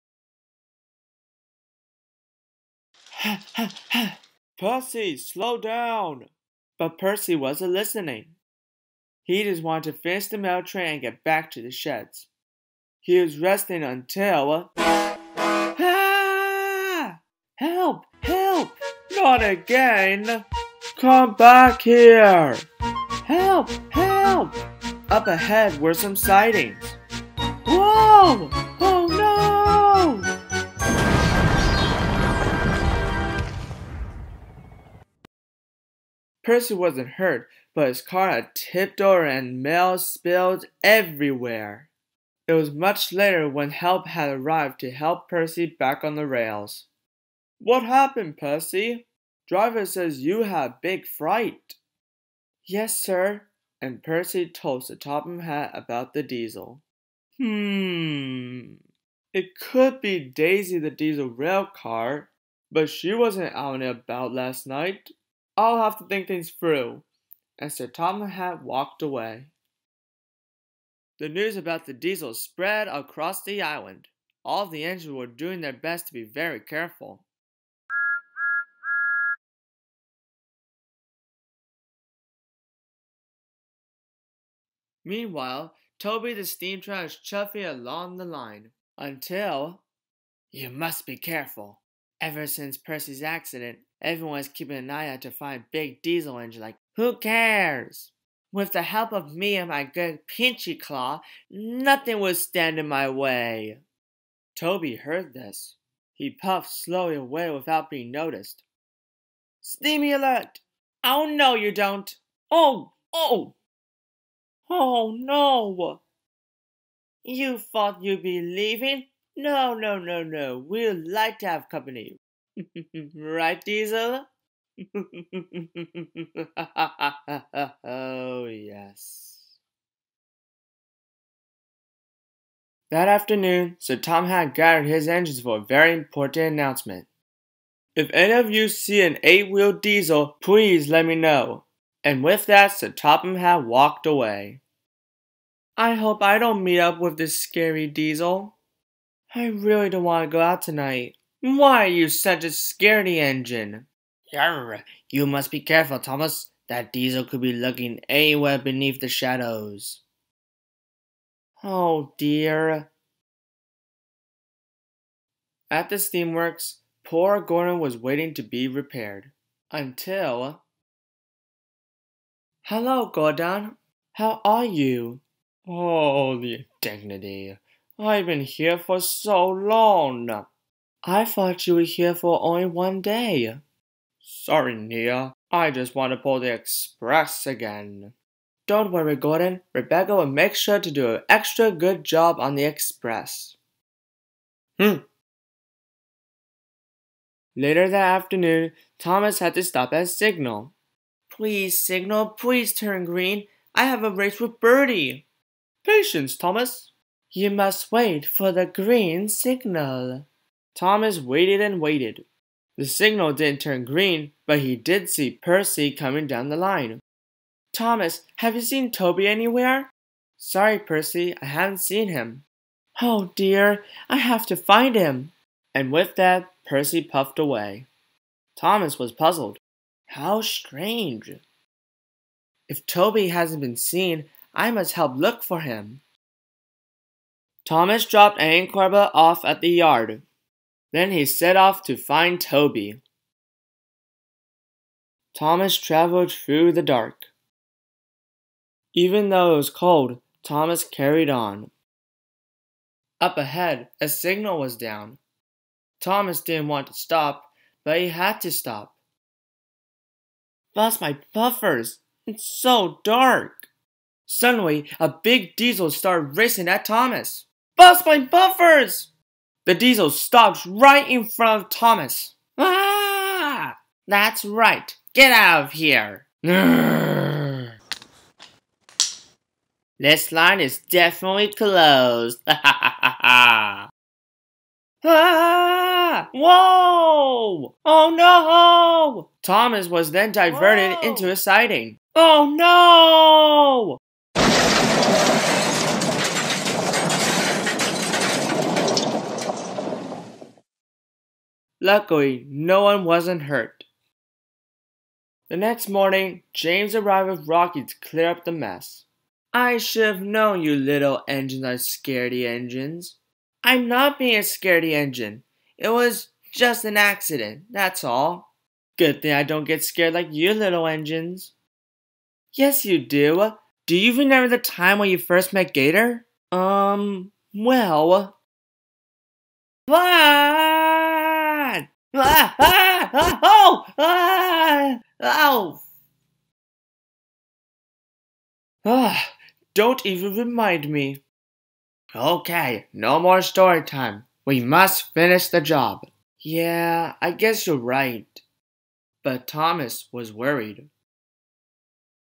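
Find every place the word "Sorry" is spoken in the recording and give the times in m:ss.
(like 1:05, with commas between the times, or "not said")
3:04, 3:40.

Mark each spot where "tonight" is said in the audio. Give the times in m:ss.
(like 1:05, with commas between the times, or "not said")
2:30.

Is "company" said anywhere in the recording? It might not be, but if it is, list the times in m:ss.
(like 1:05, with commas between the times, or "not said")
2:01.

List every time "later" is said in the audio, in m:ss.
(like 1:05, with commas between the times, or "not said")
0:43, 3:17.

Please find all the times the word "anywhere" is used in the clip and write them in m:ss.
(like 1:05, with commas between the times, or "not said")
2:38, 3:39.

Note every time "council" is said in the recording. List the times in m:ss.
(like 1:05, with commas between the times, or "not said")
not said.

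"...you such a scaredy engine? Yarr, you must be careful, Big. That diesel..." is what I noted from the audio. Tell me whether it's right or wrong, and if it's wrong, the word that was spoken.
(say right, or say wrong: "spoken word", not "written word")
wrong: "Thomas", not "Big".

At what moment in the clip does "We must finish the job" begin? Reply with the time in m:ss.
5:44.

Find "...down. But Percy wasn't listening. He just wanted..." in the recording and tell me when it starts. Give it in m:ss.
0:05.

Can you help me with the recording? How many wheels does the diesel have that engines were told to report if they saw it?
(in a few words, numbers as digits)
8.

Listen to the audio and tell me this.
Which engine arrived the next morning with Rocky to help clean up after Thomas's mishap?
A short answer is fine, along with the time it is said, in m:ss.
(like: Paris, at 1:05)
James, at 5:06.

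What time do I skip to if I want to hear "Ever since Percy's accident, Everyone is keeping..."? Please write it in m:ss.
1:32.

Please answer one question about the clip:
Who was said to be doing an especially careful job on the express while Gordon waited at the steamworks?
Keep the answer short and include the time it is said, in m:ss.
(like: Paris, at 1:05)
Rebecca, at 3:09.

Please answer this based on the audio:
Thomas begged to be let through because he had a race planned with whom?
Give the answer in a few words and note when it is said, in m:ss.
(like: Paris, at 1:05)
Birdie, at 3:24.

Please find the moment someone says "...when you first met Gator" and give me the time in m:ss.
5:24.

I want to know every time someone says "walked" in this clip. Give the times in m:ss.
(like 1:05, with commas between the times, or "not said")
1:08, 2:23.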